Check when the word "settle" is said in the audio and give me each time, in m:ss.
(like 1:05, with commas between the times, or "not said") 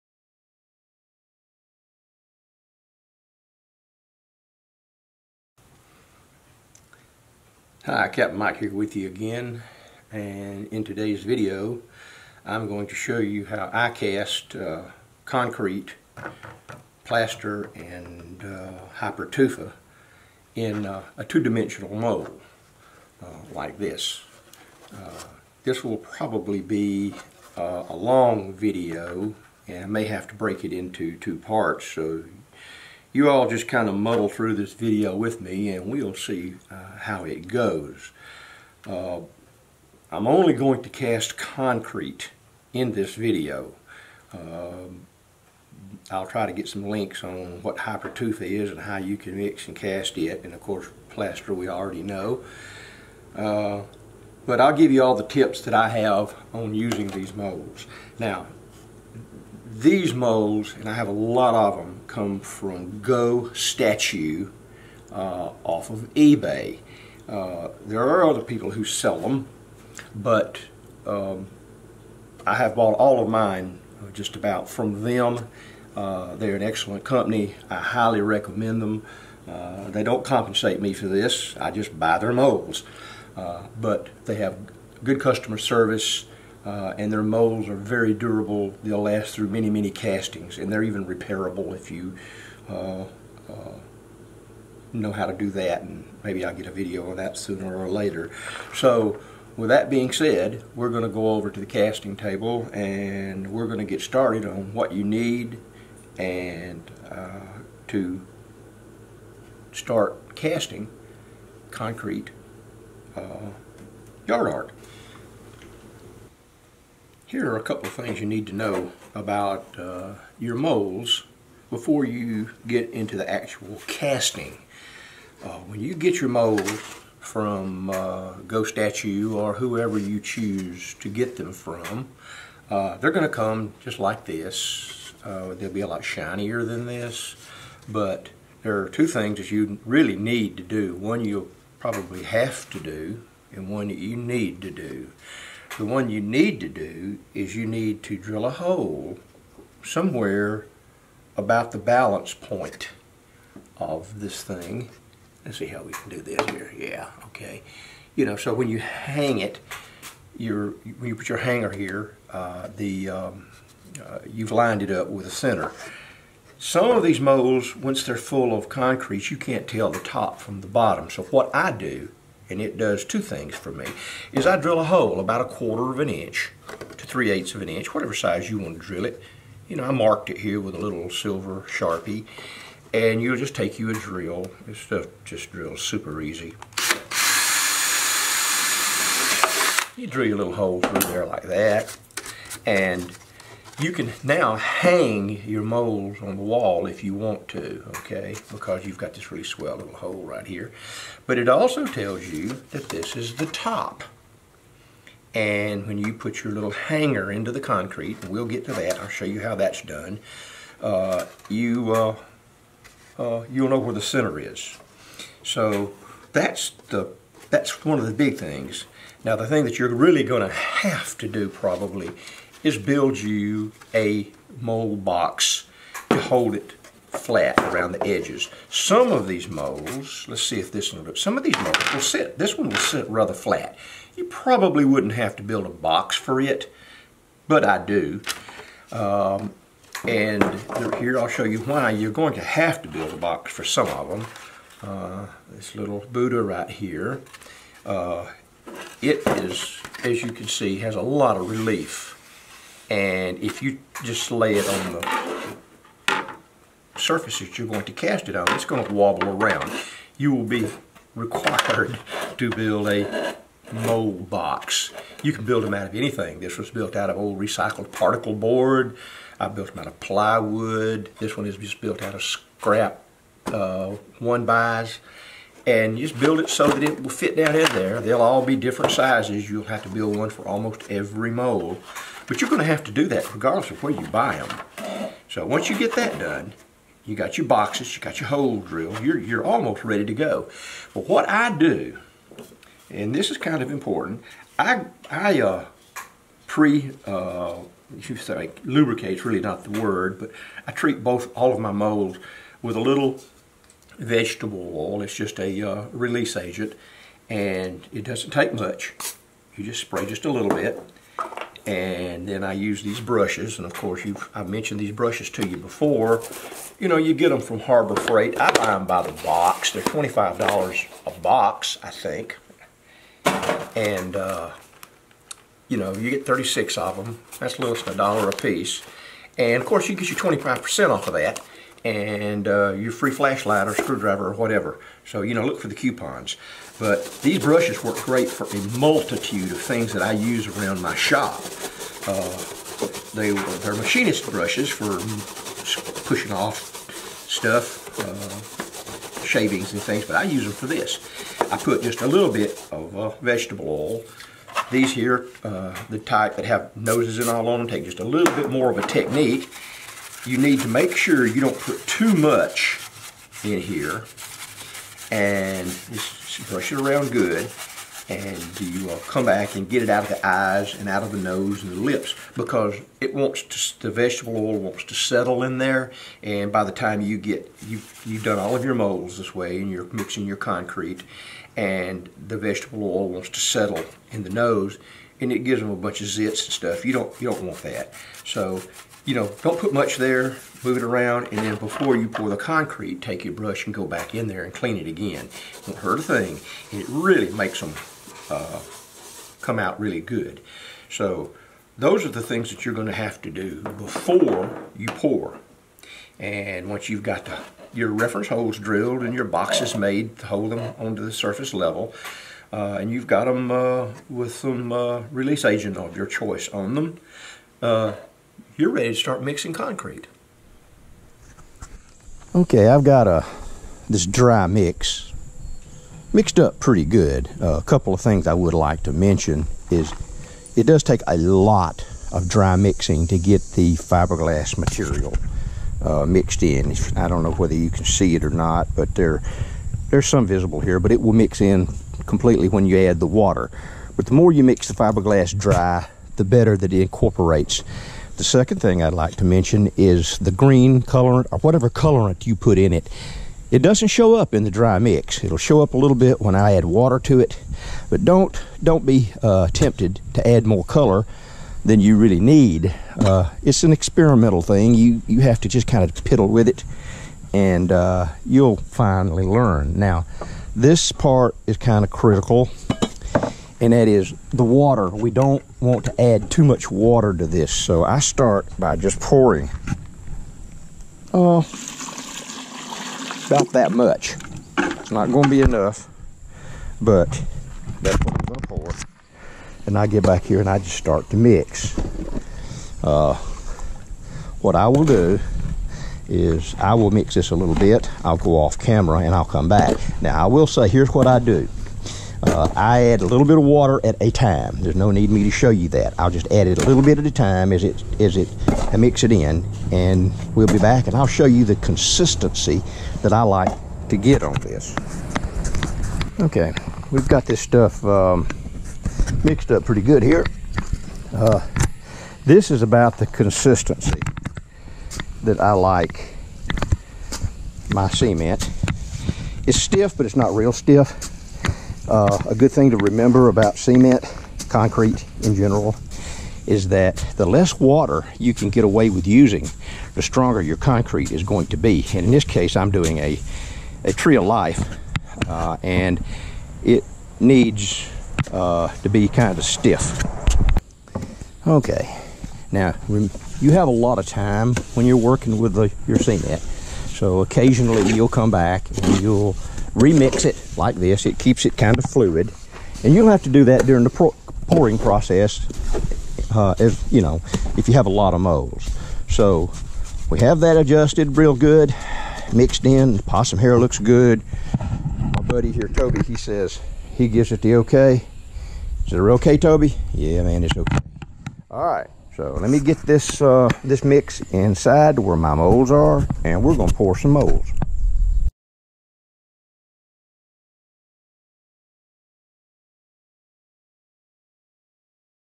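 6:14, 6:23.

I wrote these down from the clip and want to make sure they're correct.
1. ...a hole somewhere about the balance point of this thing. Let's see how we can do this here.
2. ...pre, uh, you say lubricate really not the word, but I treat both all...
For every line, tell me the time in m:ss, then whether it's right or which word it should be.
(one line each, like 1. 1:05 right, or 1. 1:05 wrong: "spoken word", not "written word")
1. 2:28 right
2. 4:56 right.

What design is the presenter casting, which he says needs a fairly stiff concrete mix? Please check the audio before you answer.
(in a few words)
tree of life.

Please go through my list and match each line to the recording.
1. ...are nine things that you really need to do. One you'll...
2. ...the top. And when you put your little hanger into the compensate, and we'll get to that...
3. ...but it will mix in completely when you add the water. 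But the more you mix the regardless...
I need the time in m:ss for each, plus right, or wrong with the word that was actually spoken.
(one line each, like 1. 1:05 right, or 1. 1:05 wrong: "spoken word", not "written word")
1. 2:18 wrong: "two", not "nine"
2. 3:23 wrong: "concrete", not "compensate"
3. 7:20 wrong: "fiberglass", not "regardless".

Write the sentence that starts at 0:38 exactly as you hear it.
Uh, I'm only going to cast concrete in this video.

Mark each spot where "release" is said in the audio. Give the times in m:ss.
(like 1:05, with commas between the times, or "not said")
5:05, 6:55.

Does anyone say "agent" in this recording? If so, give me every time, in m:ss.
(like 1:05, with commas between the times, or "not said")
5:06, 6:55.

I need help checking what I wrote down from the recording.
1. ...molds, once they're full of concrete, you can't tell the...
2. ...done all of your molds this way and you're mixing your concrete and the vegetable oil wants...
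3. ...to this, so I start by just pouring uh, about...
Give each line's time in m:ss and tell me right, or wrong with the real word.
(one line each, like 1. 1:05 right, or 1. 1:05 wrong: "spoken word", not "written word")
1. 2:47 right
2. 6:18 right
3. 7:57 right.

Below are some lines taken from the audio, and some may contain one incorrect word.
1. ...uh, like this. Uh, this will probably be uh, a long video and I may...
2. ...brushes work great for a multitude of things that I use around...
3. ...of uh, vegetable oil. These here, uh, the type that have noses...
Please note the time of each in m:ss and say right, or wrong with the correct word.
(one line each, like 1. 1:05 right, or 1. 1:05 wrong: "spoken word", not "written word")
1. 0:23 right
2. 5:37 right
3. 5:52 right.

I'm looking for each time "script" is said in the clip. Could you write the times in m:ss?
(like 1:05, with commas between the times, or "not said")
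not said.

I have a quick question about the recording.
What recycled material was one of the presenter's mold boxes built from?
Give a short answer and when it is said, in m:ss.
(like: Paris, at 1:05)
particle board, at 4:27.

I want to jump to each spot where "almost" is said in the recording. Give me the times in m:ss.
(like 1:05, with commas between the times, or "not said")
4:40, 4:49.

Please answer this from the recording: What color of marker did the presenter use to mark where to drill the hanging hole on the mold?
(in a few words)
silver.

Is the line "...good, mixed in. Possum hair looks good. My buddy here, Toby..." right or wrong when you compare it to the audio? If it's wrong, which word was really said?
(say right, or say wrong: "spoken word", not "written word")
right.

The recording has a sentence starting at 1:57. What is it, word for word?
Here are a couple of things you need to know about uh, your molds before you get into the actual casting.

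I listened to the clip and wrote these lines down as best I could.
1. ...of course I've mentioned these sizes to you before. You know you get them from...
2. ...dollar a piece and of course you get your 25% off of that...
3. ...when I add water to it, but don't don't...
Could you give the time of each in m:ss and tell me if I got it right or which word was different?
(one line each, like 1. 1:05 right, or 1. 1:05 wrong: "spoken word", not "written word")
1. 5:13 wrong: "brushes", not "sizes"
2. 5:27 right
3. 7:36 right.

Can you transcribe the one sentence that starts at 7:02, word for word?
Okay, I've got a this dry mix mixed up pretty good.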